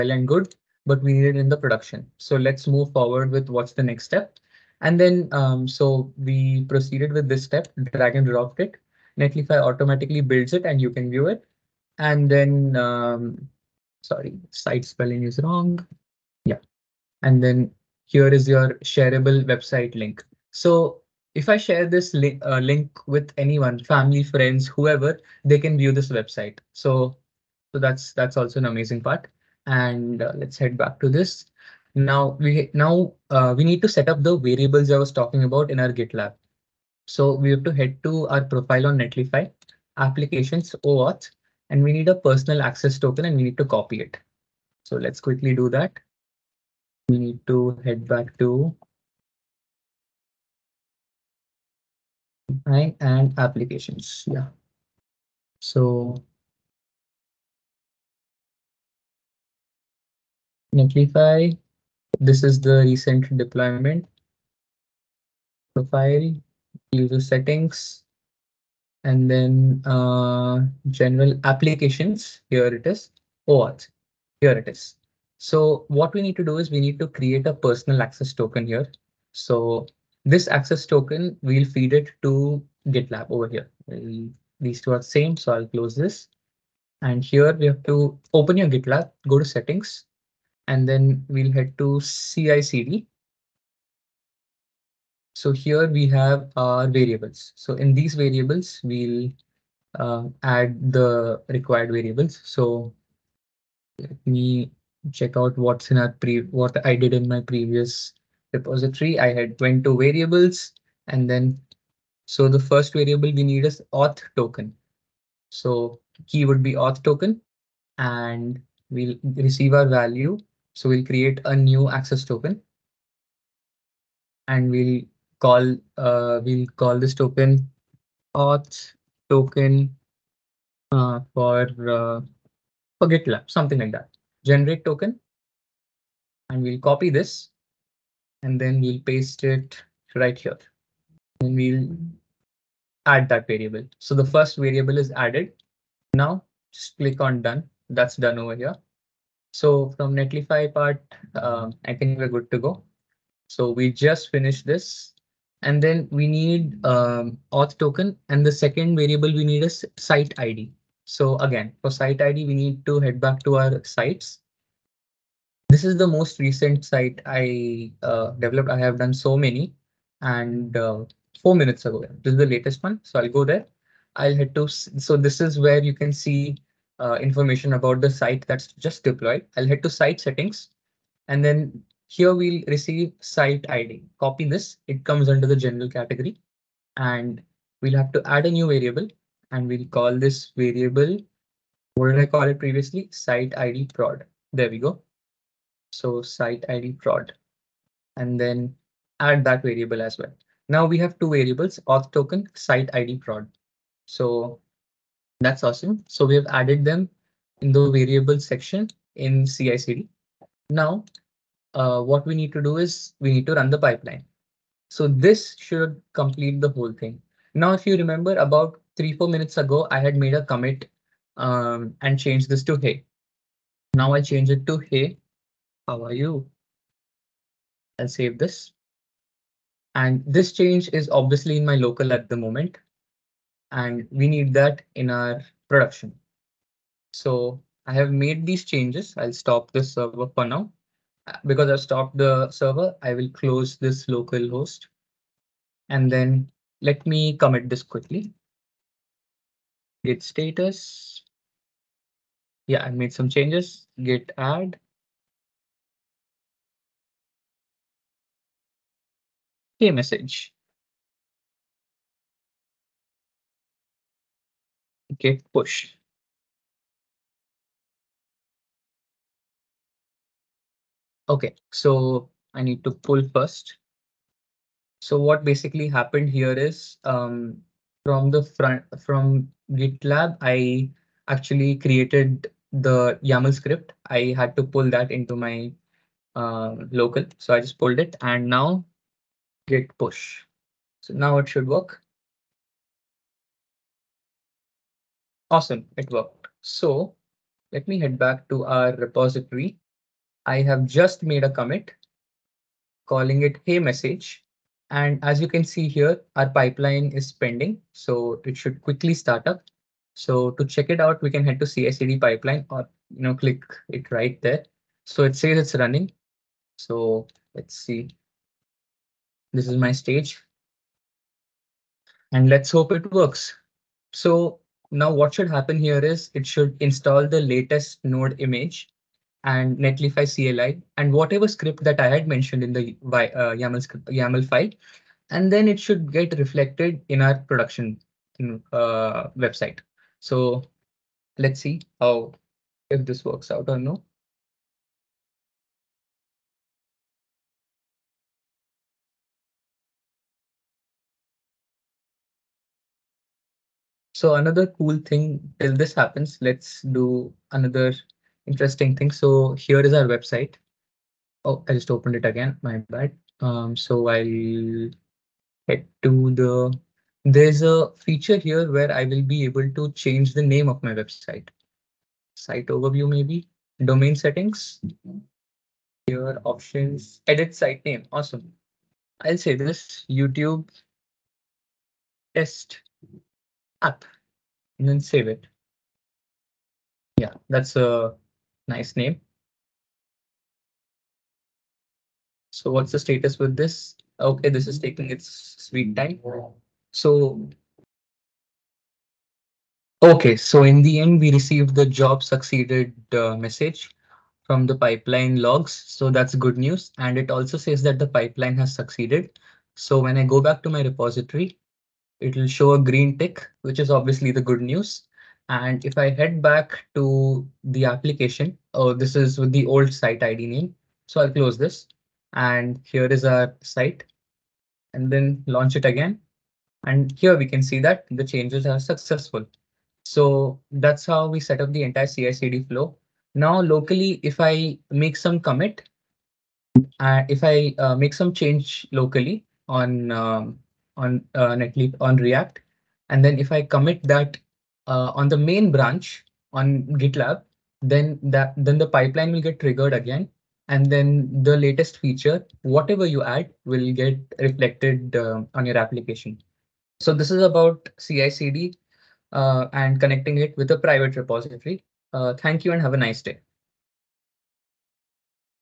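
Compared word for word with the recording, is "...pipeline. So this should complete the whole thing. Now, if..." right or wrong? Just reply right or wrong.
right.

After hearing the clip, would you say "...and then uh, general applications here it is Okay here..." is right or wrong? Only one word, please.
wrong.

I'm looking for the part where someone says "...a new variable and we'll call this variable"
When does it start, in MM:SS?
03:08.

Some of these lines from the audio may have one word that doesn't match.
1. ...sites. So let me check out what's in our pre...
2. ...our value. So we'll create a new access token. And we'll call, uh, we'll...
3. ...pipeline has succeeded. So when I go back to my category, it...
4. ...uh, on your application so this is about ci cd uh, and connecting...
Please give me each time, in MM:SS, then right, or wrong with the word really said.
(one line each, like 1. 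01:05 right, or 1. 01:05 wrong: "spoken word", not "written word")
1. 01:41 wrong: "variables", not "sites"
2. 01:59 right
3. 06:48 wrong: "repository", not "category"
4. 07:35 right.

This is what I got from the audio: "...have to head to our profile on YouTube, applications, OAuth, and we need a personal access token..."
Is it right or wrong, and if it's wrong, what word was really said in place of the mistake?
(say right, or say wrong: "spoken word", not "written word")
wrong: "Netlify", not "YouTube".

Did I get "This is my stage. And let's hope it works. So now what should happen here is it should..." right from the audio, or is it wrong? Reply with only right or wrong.
right.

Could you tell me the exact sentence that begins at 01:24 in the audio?
these two are same, so I'll close this.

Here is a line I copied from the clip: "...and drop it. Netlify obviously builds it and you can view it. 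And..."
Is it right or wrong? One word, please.
wrong.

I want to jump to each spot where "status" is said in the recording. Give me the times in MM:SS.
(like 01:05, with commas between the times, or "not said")
04:10, 06:32.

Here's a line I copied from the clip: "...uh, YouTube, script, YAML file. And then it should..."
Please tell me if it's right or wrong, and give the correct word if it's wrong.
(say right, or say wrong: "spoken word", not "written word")
wrong: "YAML", not "YouTube".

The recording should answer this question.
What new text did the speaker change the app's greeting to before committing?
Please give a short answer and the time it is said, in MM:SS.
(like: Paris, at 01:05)
hey how are you, at 03:44.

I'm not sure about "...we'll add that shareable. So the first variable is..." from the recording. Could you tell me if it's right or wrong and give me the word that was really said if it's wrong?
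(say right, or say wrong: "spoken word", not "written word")
wrong: "variable", not "shareable".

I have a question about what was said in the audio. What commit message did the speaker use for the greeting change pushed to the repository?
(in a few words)
hey message.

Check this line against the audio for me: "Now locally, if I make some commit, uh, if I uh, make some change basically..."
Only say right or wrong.
wrong.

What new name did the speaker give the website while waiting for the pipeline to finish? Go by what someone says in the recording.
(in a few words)
YouTube test app.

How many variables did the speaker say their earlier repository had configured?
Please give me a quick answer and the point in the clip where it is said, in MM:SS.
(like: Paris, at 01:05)
22, at 01:49.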